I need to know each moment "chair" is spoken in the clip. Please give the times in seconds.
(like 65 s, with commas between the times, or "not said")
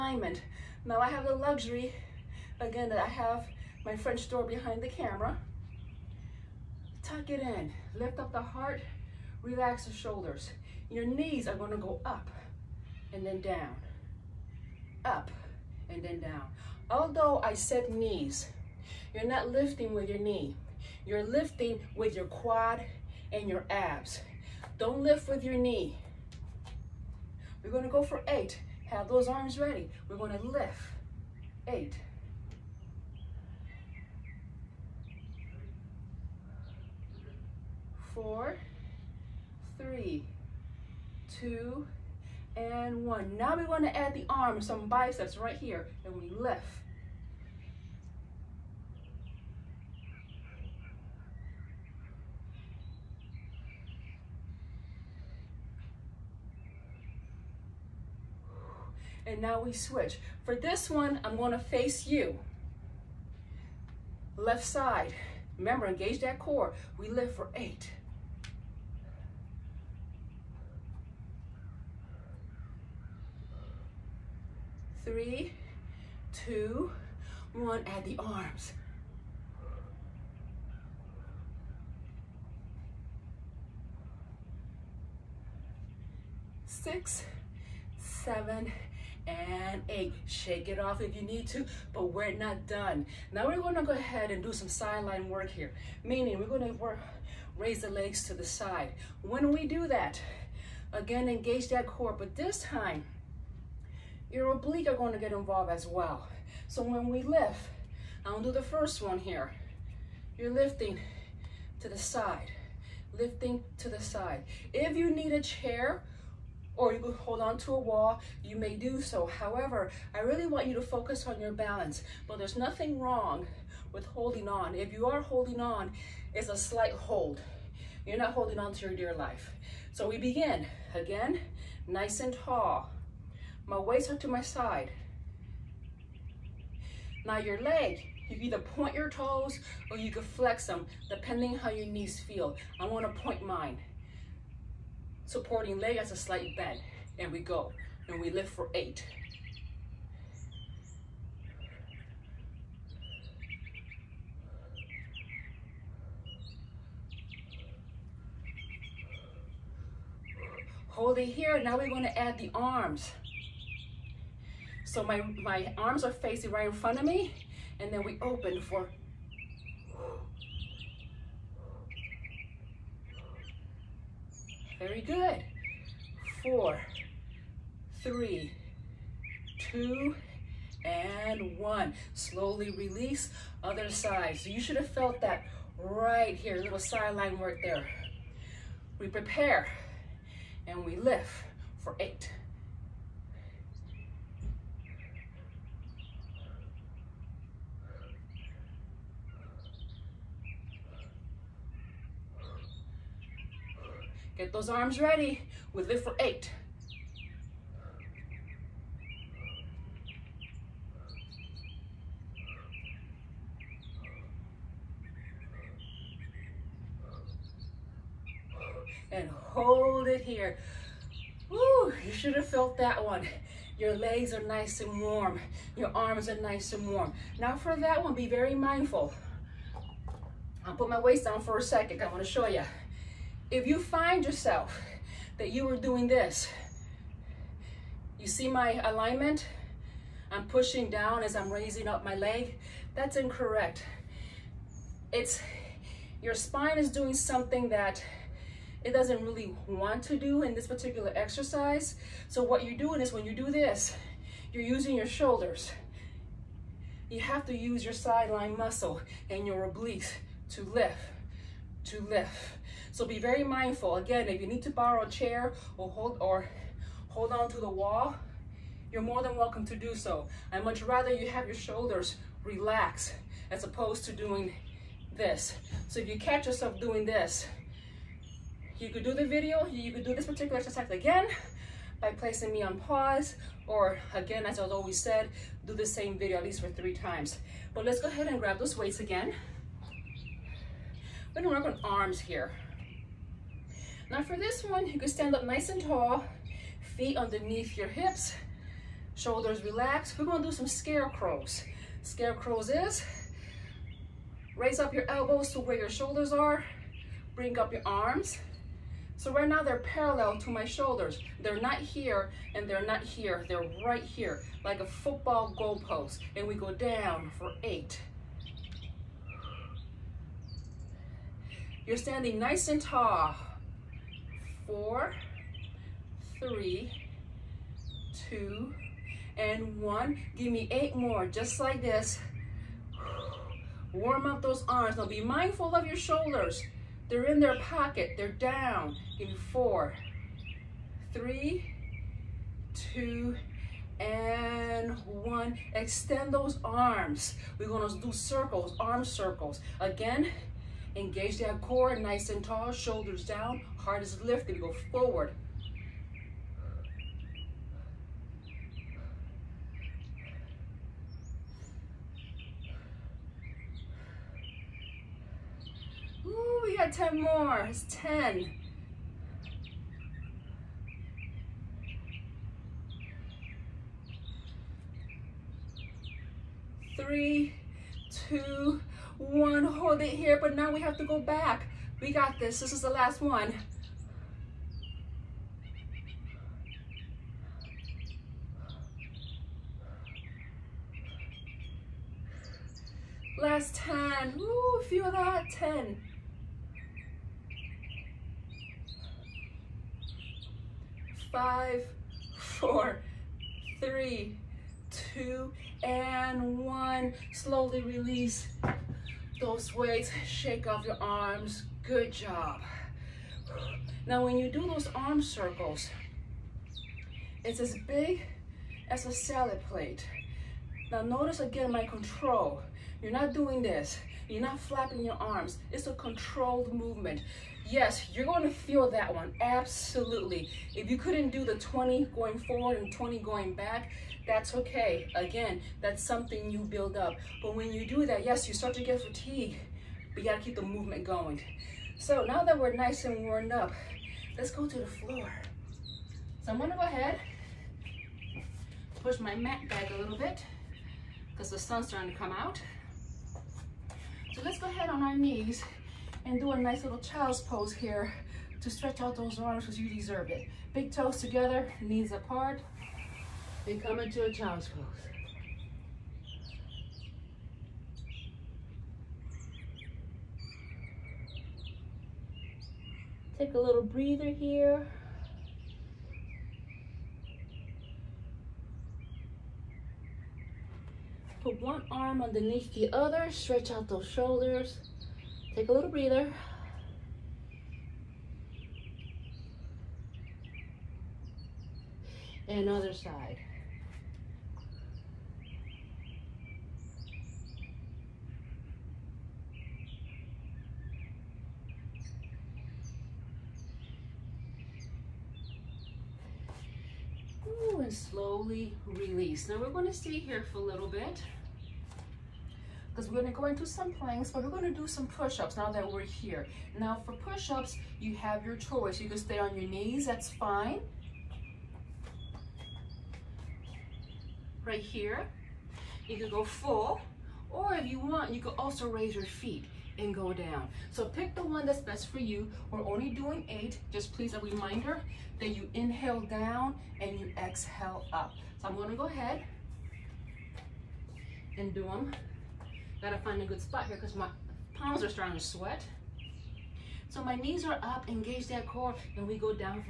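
115 s, 265 s.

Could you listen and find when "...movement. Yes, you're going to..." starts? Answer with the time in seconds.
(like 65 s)
426 s.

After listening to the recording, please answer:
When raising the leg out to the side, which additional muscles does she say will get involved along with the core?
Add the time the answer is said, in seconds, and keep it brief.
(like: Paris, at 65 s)
obliques, at 104 s.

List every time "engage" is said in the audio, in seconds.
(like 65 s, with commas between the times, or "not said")
65 s, 101 s, 350 s, 548 s.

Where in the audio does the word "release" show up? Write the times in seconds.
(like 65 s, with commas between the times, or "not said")
182 s, 407 s, 508 s.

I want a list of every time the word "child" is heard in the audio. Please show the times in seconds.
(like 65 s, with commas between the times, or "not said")
456 s, 464 s.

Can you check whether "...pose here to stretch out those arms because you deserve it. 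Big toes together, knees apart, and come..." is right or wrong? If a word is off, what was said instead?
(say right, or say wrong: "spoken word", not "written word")
right.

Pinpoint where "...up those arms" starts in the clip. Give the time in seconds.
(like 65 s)
334 s.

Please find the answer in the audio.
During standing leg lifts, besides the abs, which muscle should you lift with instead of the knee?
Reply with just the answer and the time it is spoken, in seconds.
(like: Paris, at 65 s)
quad, at 22 s.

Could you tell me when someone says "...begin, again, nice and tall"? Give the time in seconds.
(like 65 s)
130 s.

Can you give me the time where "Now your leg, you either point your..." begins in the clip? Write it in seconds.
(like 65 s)
137 s.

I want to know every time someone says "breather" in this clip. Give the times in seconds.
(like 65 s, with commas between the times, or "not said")
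473 s, 485 s.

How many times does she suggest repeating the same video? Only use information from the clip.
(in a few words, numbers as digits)
3.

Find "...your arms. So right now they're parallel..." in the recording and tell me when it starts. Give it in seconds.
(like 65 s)
307 s.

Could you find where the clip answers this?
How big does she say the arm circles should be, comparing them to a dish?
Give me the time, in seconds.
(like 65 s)
419 s.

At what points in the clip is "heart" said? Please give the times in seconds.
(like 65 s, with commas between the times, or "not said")
8 s, 353 s.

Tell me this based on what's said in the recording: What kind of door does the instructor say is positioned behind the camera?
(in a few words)
French door.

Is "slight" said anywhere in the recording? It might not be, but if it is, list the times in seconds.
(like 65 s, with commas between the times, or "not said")
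126 s, 146 s.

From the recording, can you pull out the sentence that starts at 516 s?
Now for push-ups, you have your choice.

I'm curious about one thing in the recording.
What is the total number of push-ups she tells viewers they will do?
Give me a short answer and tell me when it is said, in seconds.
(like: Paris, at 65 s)
8, at 532 s.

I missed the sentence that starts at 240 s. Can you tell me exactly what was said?
I'm pushing down as I'm raising up my leg.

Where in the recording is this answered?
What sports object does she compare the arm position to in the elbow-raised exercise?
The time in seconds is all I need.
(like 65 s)
314 s.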